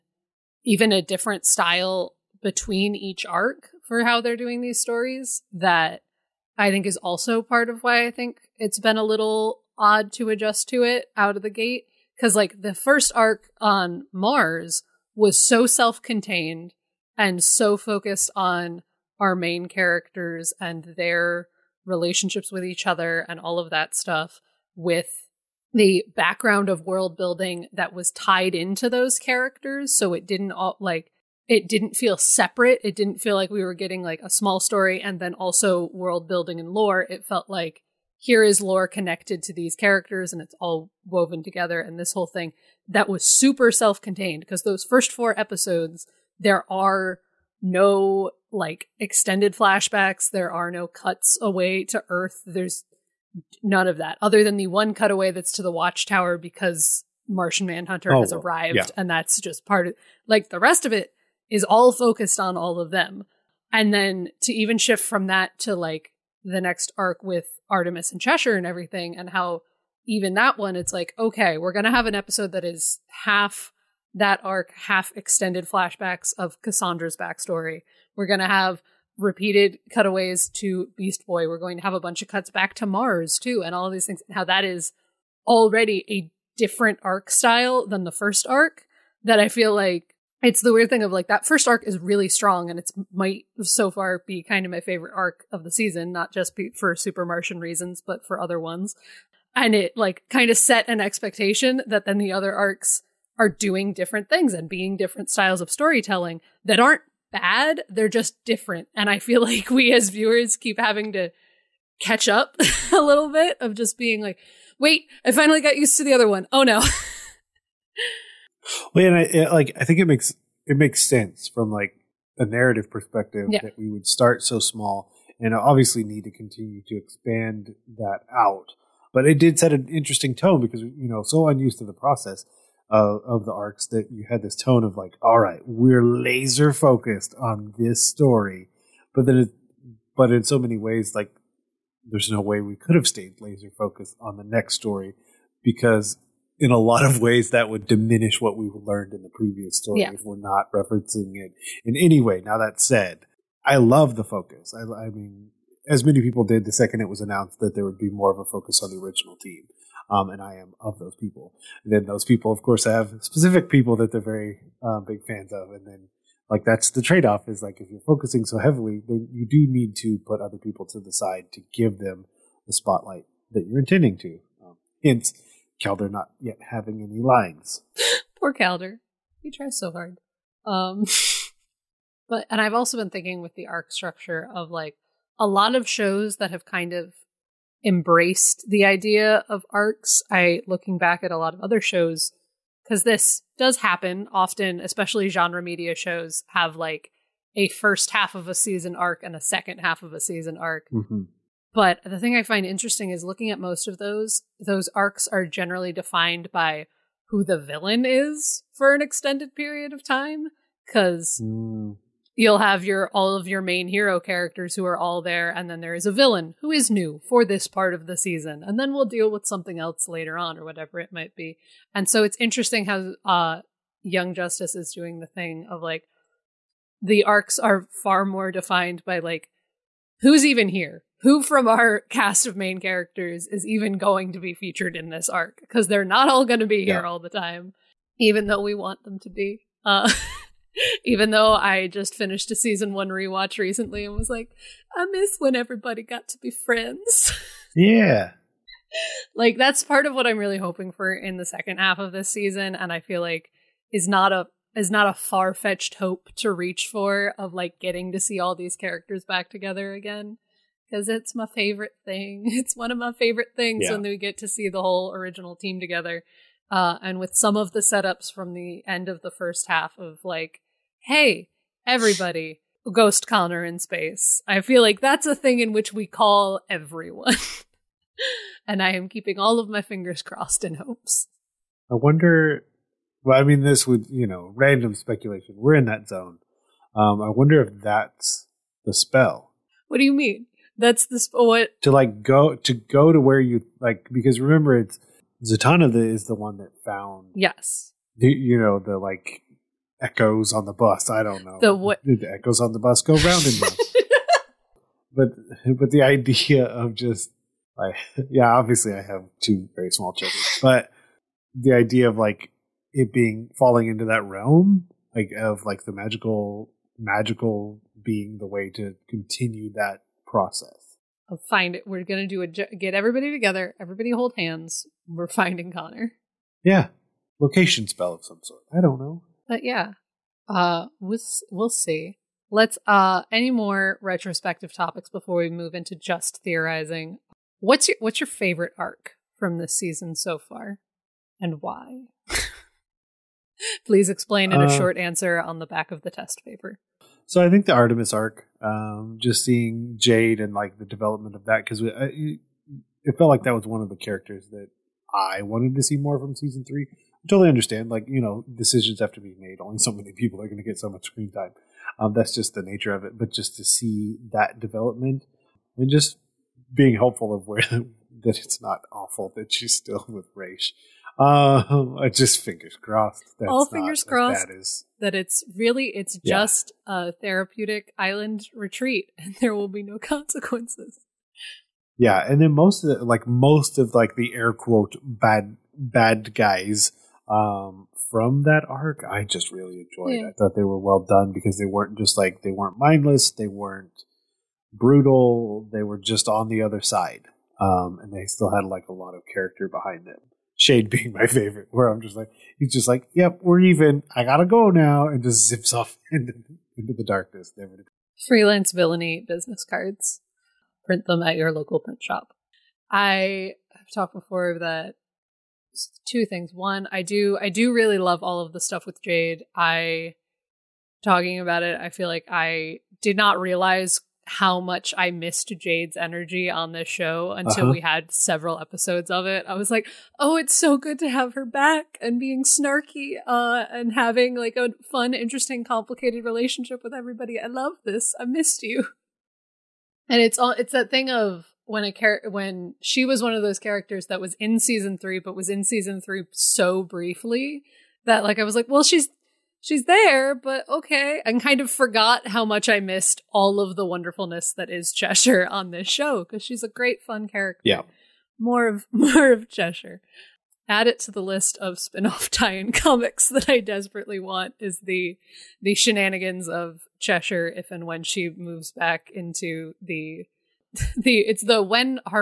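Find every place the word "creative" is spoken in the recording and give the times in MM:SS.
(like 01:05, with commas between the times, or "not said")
not said.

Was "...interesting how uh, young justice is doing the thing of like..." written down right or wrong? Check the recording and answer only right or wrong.
right.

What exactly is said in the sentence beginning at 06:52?
I have talked before that two things.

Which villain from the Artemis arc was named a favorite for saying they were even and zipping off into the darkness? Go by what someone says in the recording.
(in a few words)
Shade.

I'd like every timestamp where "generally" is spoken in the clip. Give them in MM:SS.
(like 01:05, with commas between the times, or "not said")
03:25.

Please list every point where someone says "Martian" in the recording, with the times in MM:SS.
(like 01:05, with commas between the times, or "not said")
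00:57, 01:37.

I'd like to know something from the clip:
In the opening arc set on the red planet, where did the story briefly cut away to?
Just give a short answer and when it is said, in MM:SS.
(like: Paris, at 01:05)
The Watchtower, at 00:55.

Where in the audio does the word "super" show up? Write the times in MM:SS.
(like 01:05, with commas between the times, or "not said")
00:43, 01:36.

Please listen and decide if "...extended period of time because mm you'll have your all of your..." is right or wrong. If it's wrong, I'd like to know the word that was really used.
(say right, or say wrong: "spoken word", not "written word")
right.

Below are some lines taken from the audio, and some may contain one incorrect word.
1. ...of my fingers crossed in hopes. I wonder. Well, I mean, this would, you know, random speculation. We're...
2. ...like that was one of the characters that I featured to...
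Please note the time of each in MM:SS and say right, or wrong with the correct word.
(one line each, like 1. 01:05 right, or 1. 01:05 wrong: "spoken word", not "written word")
1. 04:39 right
2. 05:53 wrong: "wanted", not "featured".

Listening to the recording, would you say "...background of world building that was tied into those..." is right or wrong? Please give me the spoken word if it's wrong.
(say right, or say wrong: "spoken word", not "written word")
right.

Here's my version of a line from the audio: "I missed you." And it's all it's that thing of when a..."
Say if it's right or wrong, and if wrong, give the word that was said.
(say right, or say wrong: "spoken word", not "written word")
right.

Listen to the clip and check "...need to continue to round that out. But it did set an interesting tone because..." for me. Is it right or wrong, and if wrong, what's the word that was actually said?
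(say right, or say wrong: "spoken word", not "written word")
wrong: "expand", not "round".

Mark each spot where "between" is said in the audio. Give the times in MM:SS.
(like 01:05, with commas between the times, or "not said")
00:02.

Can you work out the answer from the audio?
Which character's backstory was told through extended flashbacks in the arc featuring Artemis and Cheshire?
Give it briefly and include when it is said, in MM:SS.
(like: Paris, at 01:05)
Cassandra, at 01:16.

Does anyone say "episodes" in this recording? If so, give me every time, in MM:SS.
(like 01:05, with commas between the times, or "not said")
00:45, 01:12, 07:08.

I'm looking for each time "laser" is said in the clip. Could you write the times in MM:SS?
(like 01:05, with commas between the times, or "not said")
02:16, 02:23.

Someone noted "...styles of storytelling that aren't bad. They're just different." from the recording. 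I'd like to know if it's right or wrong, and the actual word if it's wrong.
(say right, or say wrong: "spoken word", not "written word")
right.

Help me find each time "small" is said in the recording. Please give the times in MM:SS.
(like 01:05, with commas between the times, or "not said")
00:34, 02:04, 05:09.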